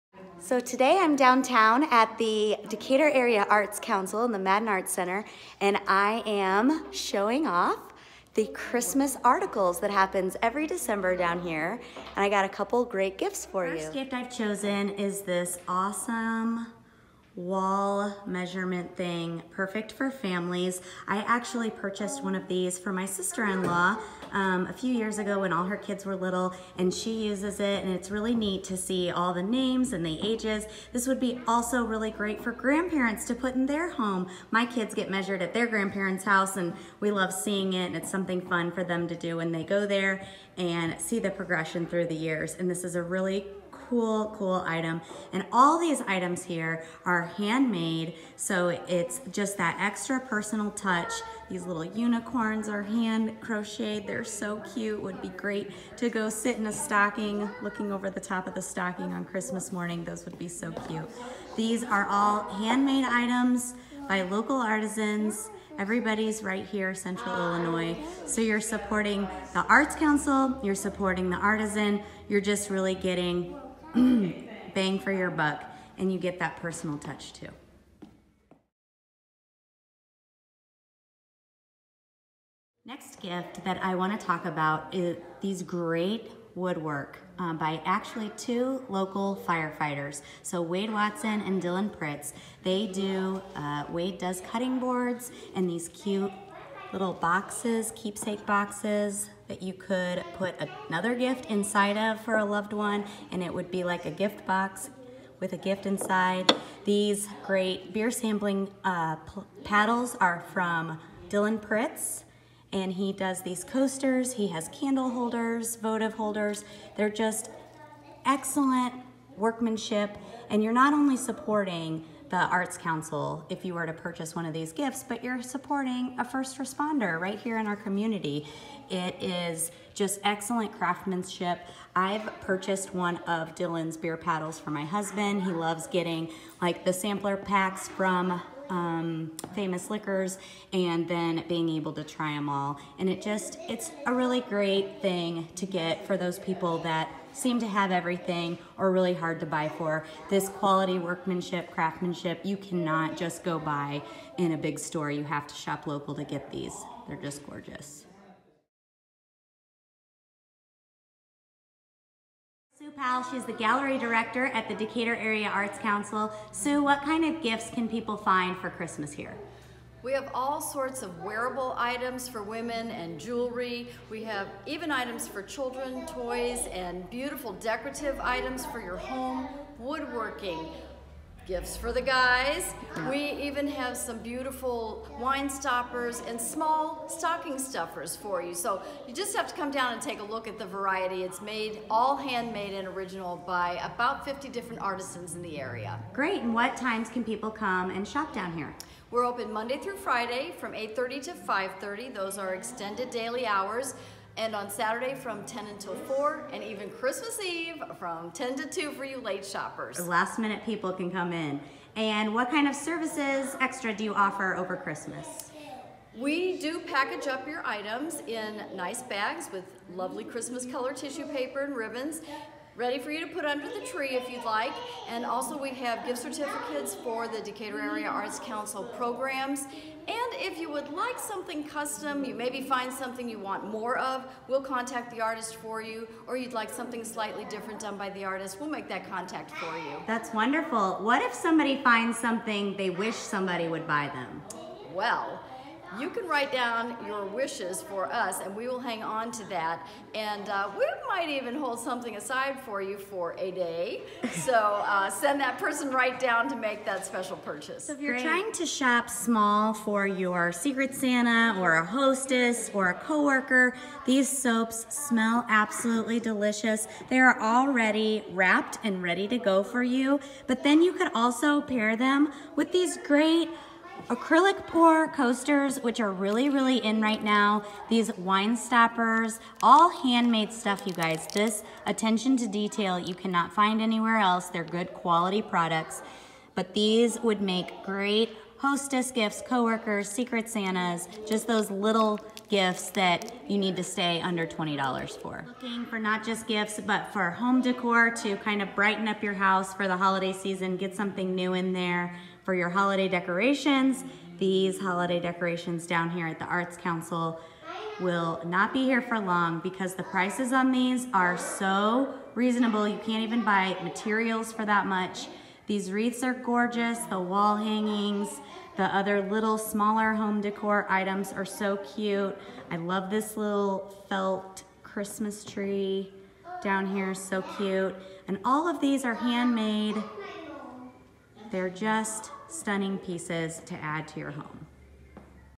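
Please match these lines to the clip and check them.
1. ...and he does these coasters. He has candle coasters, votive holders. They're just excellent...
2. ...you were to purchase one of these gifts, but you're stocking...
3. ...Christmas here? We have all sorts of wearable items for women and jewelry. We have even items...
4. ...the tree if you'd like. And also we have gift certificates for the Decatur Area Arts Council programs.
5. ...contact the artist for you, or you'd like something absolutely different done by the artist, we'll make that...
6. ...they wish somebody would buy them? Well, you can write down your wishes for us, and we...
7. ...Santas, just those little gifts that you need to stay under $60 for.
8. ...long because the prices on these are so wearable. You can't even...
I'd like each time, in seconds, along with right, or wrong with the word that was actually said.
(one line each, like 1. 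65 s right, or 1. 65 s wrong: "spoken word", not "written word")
1. 112 s wrong: "holders", not "coasters"
2. 123 s wrong: "supporting", not "stocking"
3. 168 s right
4. 223 s right
5. 234 s wrong: "slightly", not "absolutely"
6. 242 s right
7. 290 s wrong: "20", not "60"
8. 309 s wrong: "reasonable", not "wearable".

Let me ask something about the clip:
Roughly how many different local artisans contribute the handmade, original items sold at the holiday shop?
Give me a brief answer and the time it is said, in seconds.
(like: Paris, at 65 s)
50, at 194 s.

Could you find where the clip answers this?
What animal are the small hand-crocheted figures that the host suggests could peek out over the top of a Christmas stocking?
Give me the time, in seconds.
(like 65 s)
51 s.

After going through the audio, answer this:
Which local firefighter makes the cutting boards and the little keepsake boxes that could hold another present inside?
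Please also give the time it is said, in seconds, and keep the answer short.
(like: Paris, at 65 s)
Wade Watson, at 90 s.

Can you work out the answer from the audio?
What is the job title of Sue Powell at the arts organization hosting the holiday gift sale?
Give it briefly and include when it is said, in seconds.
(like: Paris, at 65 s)
Gallery director, at 163 s.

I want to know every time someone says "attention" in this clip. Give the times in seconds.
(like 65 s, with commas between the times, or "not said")
281 s.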